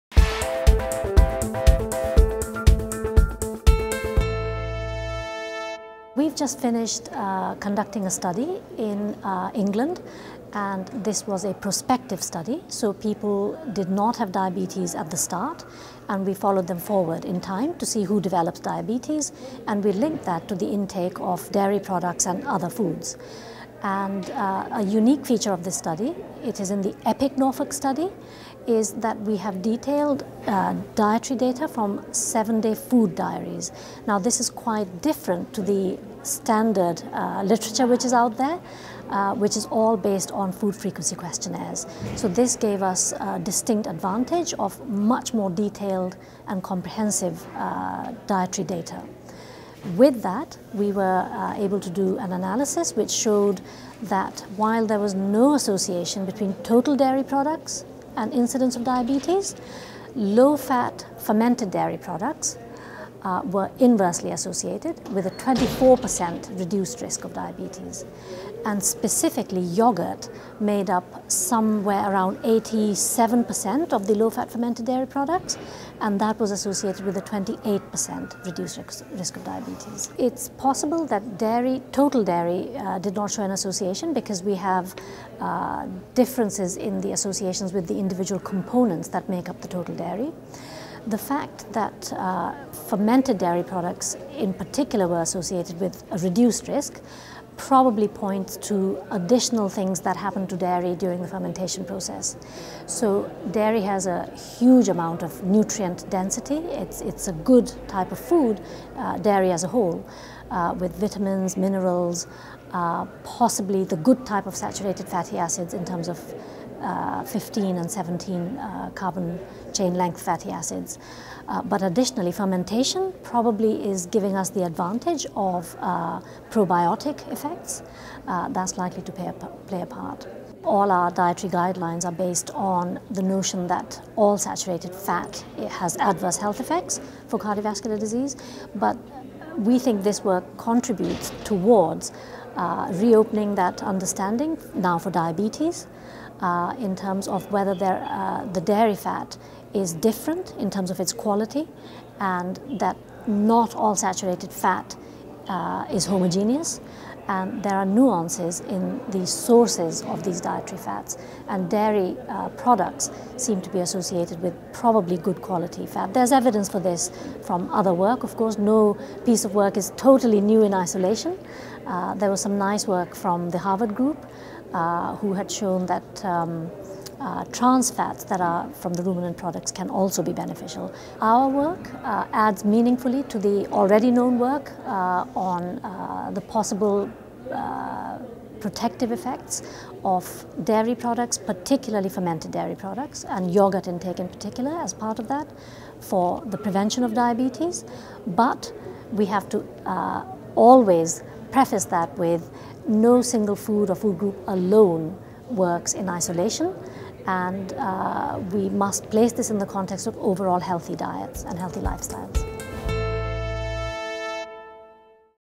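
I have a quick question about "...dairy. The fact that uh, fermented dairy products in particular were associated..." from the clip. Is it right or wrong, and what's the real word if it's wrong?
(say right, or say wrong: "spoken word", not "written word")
right.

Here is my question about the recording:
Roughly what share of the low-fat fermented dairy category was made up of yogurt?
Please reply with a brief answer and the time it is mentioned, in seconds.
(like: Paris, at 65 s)
87%, at 72 s.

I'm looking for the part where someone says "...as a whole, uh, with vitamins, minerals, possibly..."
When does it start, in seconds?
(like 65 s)
109 s.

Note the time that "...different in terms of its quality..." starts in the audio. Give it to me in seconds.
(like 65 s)
149 s.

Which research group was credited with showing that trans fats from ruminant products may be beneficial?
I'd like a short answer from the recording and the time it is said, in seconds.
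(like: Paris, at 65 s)
Harvard group, at 173 s.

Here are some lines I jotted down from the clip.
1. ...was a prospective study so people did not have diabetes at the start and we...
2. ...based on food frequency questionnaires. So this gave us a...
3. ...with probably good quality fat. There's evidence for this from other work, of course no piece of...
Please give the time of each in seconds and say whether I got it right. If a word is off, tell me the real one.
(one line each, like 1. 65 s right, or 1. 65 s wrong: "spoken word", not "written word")
1. 11 s right
2. 39 s right
3. 164 s right.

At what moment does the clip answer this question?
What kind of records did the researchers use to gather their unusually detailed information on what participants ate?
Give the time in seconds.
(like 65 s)
32 s.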